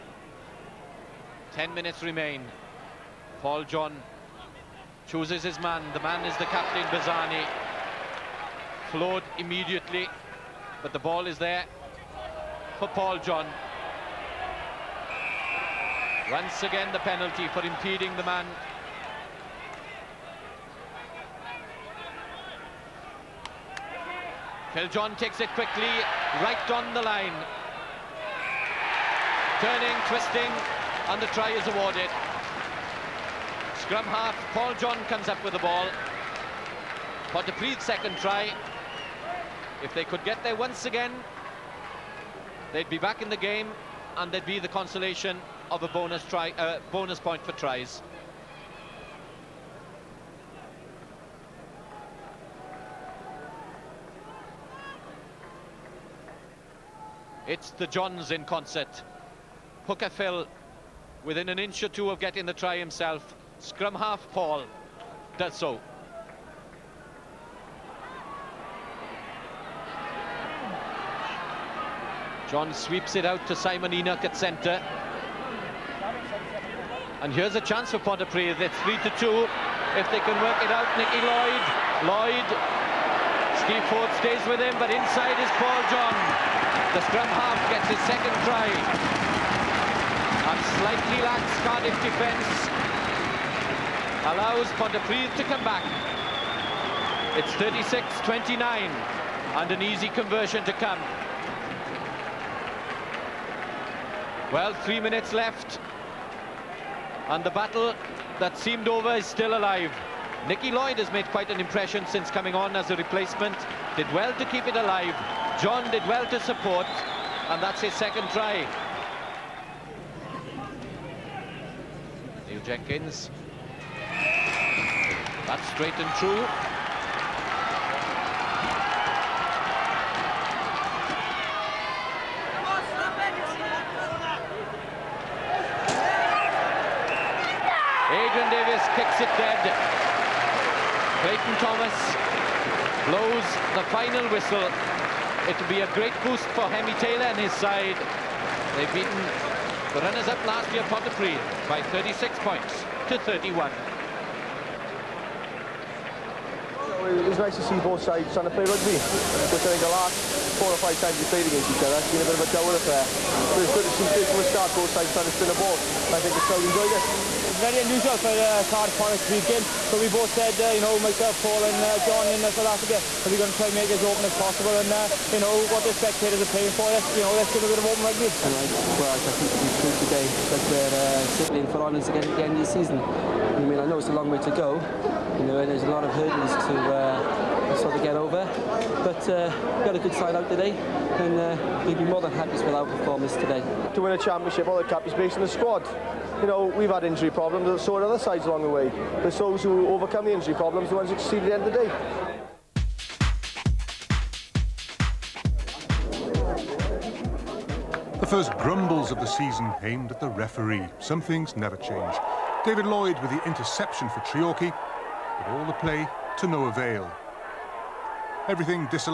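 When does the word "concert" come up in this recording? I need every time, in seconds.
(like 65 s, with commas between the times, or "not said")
58 s.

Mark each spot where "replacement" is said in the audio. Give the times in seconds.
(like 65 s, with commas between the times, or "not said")
112 s.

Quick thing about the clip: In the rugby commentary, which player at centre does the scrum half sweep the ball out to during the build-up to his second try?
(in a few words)
Simon Enoch.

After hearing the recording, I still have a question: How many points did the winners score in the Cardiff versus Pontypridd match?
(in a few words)
36.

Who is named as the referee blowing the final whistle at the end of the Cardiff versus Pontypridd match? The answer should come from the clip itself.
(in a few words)
Clayton Thomas.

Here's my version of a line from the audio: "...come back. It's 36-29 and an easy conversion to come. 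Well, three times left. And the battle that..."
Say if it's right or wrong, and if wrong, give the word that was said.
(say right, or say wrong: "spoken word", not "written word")
wrong: "minutes", not "times".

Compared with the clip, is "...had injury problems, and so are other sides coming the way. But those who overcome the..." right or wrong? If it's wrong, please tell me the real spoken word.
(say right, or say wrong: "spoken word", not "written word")
wrong: "along", not "coming".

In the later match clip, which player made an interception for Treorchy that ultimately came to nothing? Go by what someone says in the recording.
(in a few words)
David Lloyd.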